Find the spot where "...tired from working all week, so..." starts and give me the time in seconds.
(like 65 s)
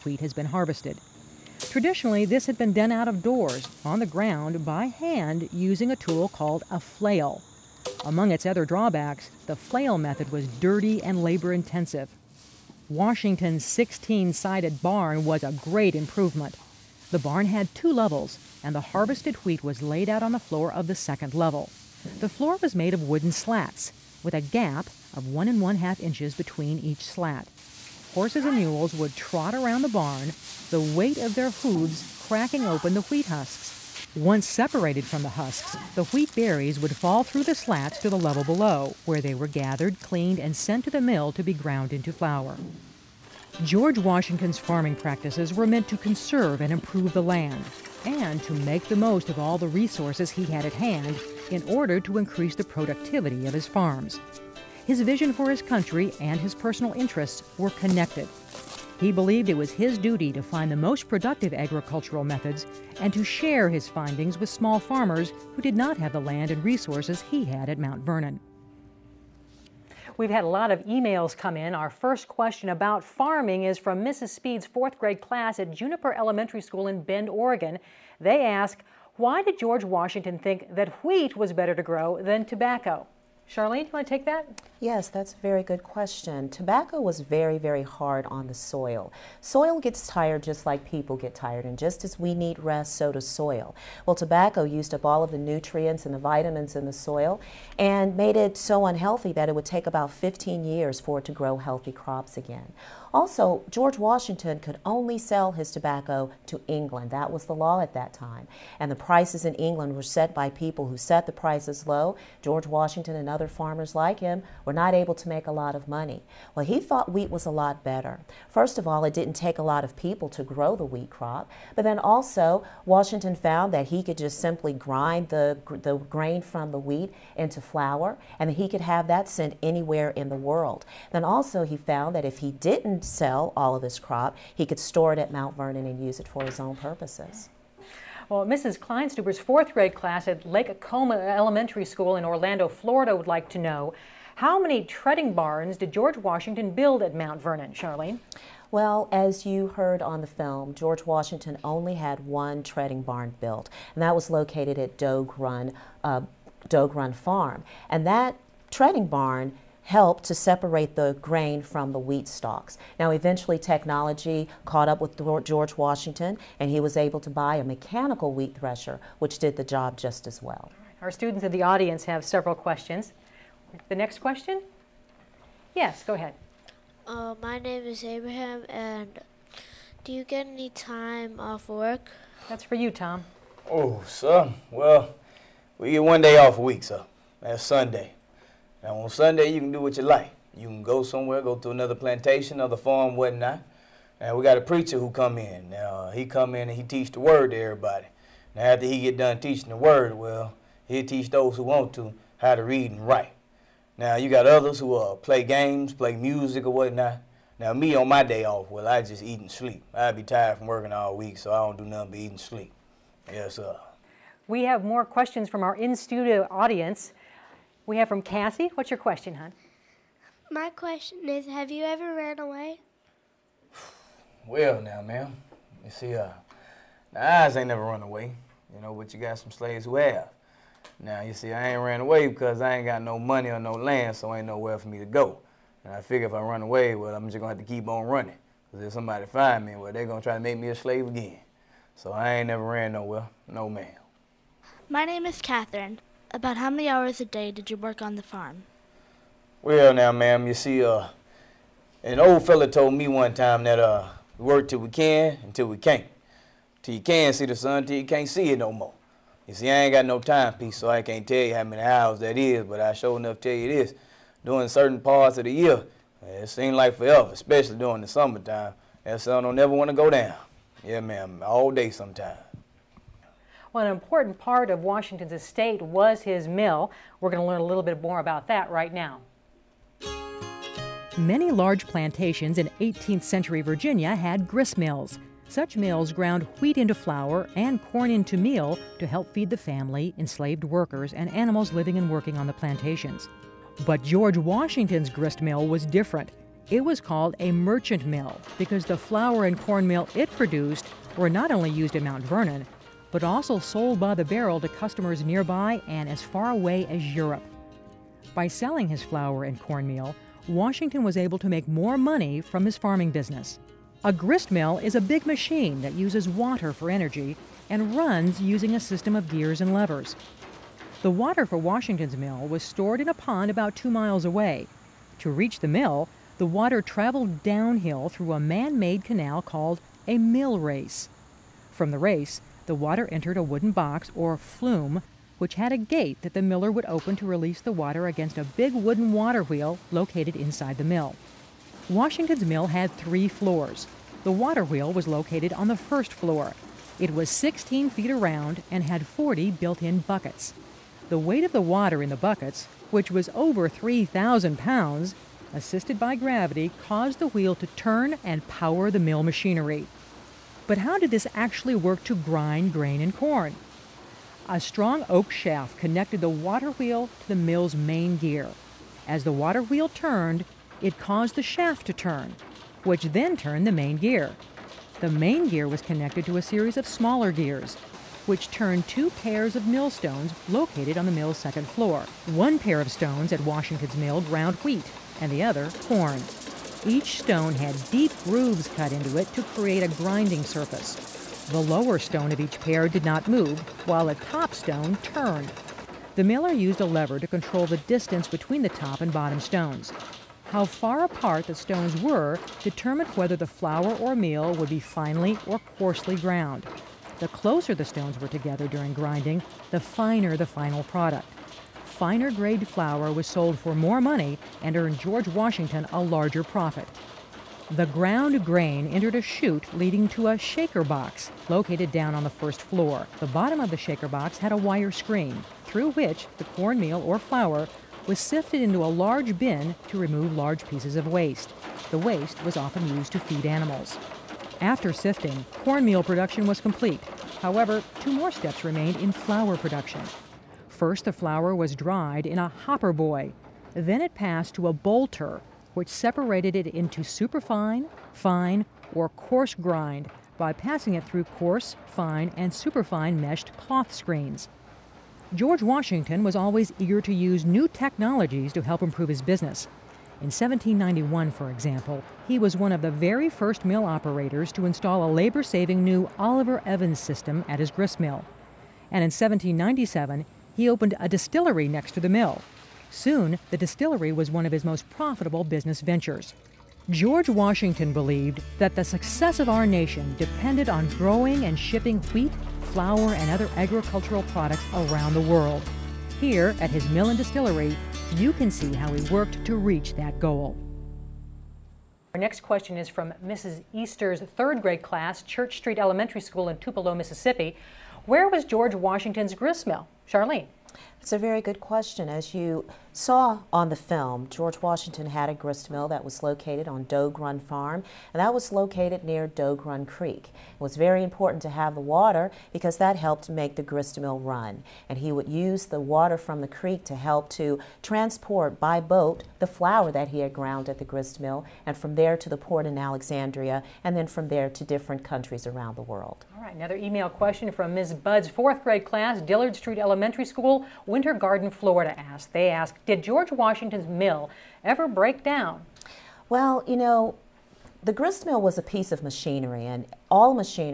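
210 s.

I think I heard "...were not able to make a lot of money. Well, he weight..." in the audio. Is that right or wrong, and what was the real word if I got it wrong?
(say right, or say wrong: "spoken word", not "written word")
wrong: "thought", not "weight".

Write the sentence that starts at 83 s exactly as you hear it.
Charlene, you want to take that?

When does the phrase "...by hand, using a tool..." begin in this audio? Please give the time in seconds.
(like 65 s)
4 s.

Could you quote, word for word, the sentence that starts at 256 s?
Till you can see the sun, till you can't see it no more.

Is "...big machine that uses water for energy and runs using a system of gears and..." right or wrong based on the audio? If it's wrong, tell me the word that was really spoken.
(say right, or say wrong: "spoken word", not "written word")
right.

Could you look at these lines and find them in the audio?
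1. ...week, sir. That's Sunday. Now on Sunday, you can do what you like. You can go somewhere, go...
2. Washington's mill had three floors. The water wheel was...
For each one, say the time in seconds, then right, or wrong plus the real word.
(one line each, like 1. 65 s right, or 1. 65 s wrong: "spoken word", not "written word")
1. 186 s right
2. 341 s right.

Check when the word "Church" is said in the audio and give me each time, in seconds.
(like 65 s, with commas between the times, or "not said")
495 s.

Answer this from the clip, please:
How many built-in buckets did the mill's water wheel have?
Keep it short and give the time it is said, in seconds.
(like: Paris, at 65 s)
40, at 349 s.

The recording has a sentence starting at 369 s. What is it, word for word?
As the water wheel turned, it caused the shaft to turn, which then turned the main gear.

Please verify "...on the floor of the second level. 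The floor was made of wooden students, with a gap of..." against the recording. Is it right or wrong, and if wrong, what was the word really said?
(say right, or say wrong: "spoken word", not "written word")
wrong: "slats", not "students".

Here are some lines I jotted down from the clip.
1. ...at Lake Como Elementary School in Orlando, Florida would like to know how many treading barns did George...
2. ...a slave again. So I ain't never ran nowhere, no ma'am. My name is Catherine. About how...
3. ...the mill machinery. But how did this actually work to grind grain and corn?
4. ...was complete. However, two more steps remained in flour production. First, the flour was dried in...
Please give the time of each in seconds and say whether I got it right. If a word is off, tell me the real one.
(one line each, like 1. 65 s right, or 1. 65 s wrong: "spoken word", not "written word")
1. 140 s right
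2. 240 s right
3. 358 s right
4. 436 s right.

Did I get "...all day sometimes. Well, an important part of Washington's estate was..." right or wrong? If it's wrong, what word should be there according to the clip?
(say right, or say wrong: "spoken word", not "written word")
right.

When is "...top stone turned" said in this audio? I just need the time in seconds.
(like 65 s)
394 s.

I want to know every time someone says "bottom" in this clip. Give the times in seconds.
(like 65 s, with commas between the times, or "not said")
399 s, 423 s.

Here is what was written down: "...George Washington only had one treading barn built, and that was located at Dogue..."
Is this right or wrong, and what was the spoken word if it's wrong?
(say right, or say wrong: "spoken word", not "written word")
right.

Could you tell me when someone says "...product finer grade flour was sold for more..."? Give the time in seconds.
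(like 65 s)
410 s.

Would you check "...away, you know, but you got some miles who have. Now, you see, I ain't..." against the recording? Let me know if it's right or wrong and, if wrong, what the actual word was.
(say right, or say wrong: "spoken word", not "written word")
wrong: "slaves", not "miles".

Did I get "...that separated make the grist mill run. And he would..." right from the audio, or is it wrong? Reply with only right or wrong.
wrong.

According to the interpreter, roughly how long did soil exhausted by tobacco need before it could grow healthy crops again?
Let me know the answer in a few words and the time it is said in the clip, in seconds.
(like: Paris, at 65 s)
15 years, at 100 s.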